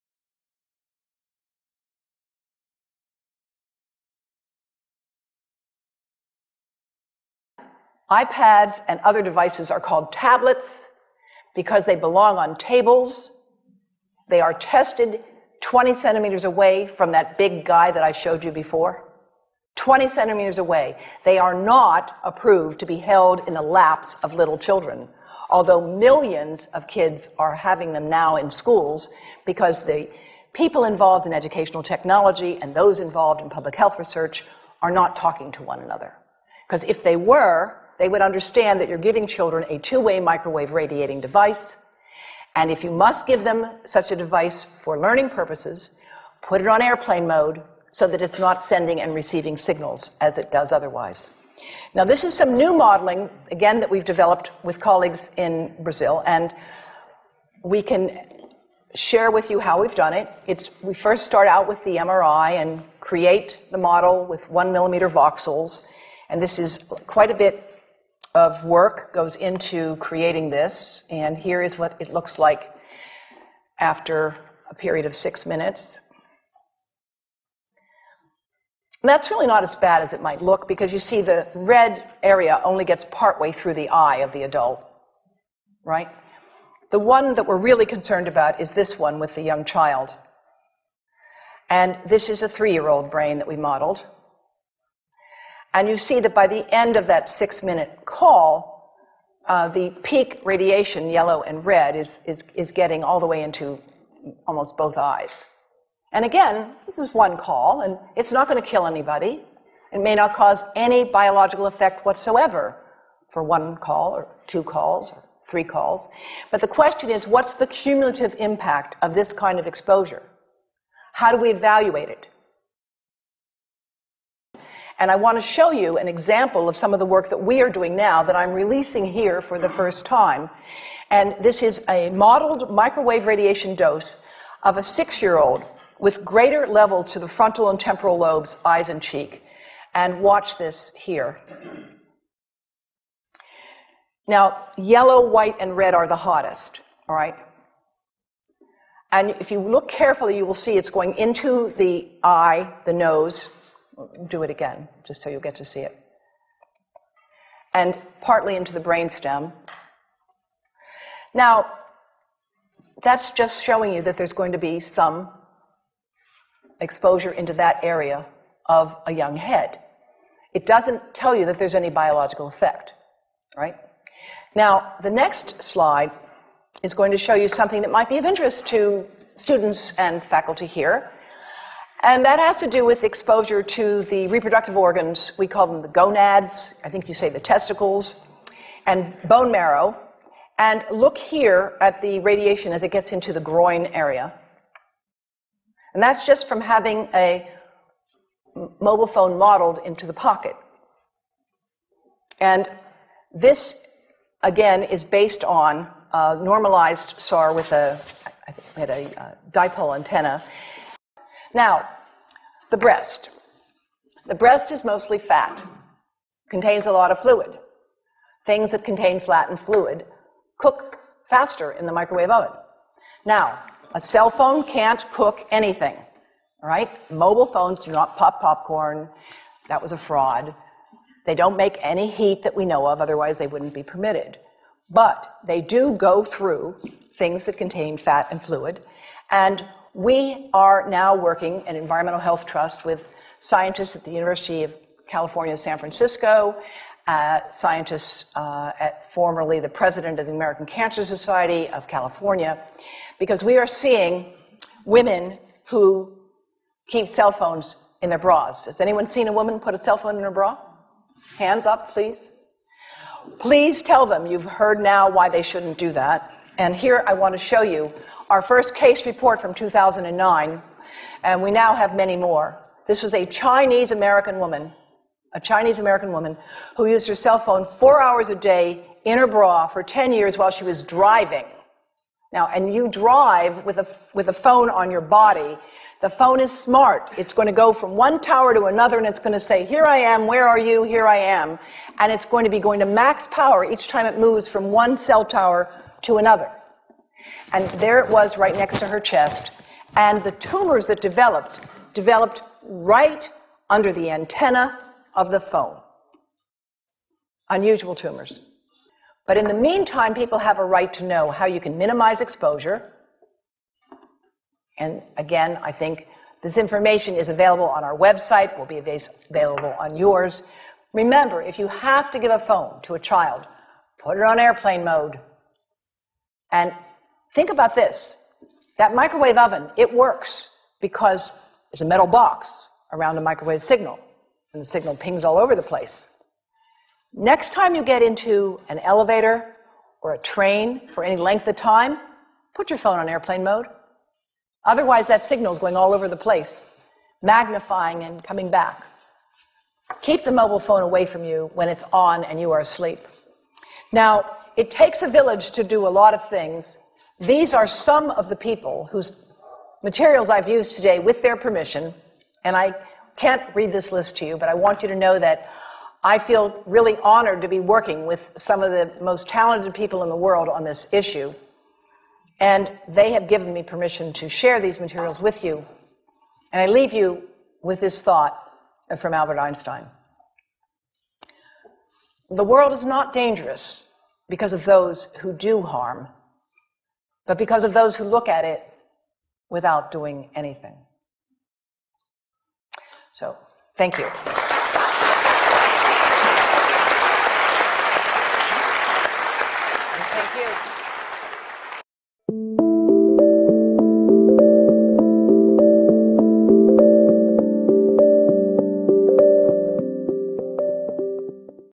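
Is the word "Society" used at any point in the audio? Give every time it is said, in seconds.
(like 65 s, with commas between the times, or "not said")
251 s.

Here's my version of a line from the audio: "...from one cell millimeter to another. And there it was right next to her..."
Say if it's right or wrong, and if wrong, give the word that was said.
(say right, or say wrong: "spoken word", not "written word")
wrong: "tower", not "millimeter".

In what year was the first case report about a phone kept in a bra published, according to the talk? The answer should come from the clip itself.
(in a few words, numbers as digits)
2009.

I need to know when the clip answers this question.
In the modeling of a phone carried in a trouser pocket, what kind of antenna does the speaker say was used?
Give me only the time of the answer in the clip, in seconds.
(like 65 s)
209 s.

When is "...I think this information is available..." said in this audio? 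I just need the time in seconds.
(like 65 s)
315 s.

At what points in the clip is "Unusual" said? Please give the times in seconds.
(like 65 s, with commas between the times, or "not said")
307 s.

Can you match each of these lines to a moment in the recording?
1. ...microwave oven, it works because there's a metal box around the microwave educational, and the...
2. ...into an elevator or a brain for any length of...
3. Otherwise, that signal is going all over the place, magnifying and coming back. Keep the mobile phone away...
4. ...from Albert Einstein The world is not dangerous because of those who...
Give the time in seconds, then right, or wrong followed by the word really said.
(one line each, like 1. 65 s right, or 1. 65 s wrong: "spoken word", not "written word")
1. 328 s wrong: "signal", not "educational"
2. 338 s wrong: "train", not "brain"
3. 344 s right
4. 378 s right.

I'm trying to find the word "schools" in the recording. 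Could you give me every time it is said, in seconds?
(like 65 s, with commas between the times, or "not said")
28 s.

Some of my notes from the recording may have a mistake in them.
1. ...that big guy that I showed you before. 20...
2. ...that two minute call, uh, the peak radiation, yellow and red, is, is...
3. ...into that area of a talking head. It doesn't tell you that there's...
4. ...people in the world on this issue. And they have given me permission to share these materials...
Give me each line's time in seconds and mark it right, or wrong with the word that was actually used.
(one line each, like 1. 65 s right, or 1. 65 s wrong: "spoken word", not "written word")
1. 17 s right
2. 97 s wrong: "six", not "two"
3. 167 s wrong: "young", not "talking"
4. 369 s right.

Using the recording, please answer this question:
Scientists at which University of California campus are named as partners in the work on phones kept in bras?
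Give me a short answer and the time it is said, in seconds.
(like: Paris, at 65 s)
San Francisco, at 245 s.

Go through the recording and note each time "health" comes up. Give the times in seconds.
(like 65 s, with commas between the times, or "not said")
33 s, 242 s.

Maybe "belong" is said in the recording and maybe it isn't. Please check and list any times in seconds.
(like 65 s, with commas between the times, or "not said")
11 s.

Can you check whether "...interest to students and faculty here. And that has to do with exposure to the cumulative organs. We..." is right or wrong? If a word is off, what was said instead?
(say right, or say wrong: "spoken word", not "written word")
wrong: "reproductive", not "cumulative".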